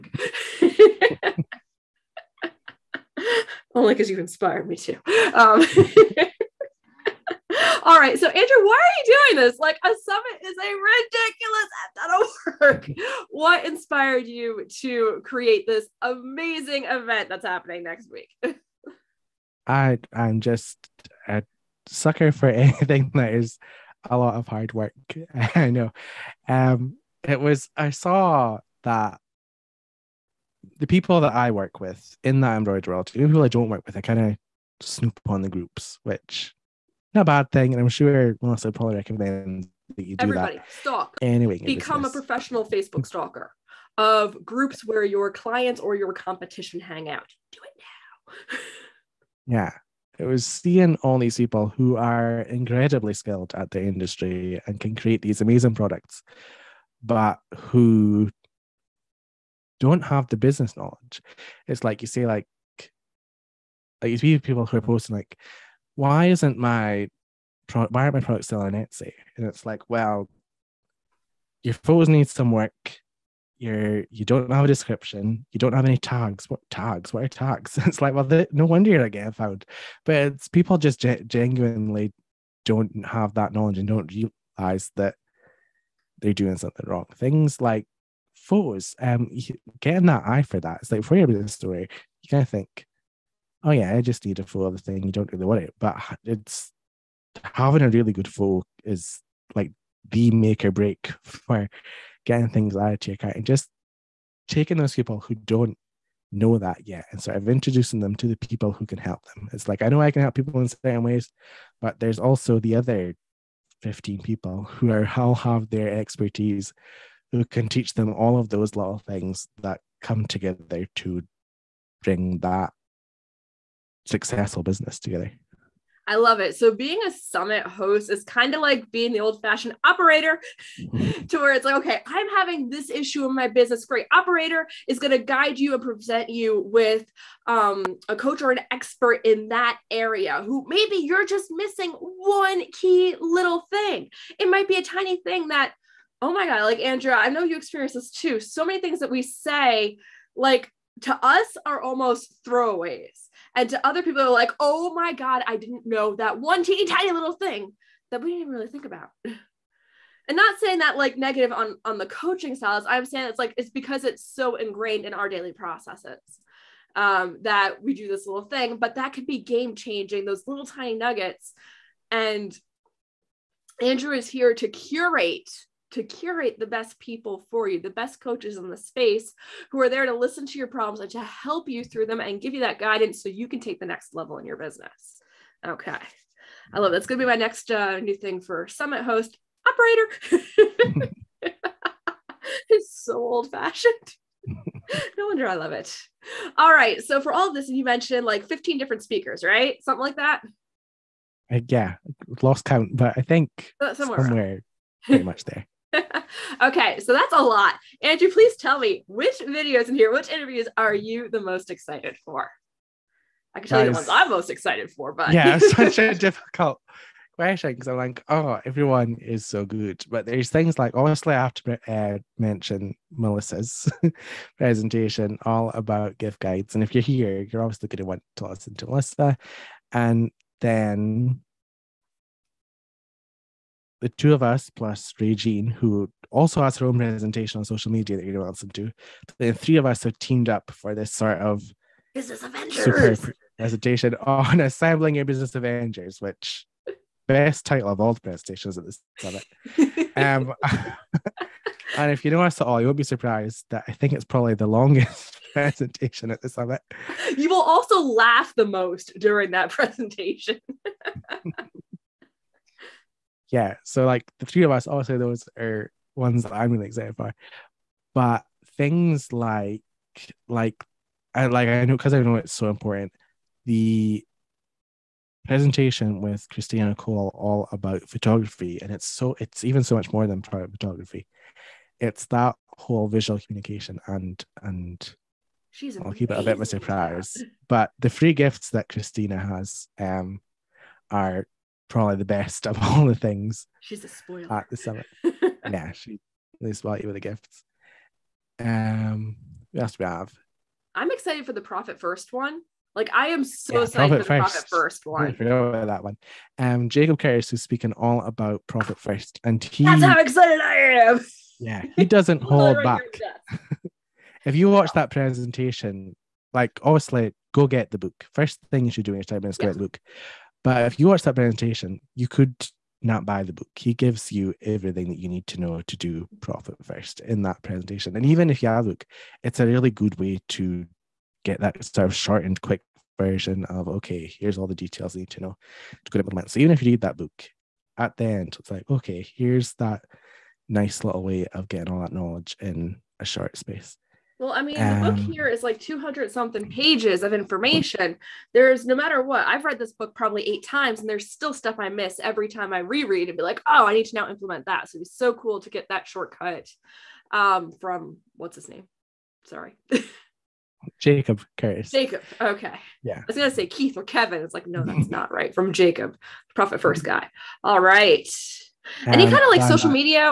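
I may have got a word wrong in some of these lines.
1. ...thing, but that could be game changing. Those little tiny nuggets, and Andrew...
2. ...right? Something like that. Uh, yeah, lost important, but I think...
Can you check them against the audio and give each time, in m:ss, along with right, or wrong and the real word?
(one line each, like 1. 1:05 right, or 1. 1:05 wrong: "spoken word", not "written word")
1. 2:48 right
2. 3:19 wrong: "count", not "important".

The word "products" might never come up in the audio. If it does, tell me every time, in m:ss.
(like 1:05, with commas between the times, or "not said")
0:55, 1:08.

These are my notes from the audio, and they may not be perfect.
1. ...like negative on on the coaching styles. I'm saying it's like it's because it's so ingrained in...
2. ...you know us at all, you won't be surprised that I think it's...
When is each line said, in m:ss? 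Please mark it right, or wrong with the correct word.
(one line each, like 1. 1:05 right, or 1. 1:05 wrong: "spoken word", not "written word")
1. 2:40 right
2. 4:12 right.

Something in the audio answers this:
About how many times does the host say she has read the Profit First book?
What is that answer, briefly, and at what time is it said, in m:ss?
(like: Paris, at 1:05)
8, at 5:50.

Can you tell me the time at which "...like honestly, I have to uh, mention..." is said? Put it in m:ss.
3:40.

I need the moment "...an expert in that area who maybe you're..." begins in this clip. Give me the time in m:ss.
2:18.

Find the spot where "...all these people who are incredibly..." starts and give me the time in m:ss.
0:50.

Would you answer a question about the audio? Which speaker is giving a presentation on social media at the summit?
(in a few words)
Regine.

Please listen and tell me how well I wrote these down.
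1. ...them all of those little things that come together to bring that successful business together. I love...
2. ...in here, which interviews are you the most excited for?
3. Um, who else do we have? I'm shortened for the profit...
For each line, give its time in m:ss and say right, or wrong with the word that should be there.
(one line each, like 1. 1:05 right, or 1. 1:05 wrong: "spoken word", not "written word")
1. 1:57 right
2. 3:29 right
3. 4:58 wrong: "excited", not "shortened".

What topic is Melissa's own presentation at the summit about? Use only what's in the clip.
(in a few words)
Gift guides.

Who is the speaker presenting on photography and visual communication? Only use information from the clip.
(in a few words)
Christina Cole.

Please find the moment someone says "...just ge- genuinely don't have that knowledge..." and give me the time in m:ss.
1:20.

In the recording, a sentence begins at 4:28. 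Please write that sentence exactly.
But things like like I like I know because I know it's so important.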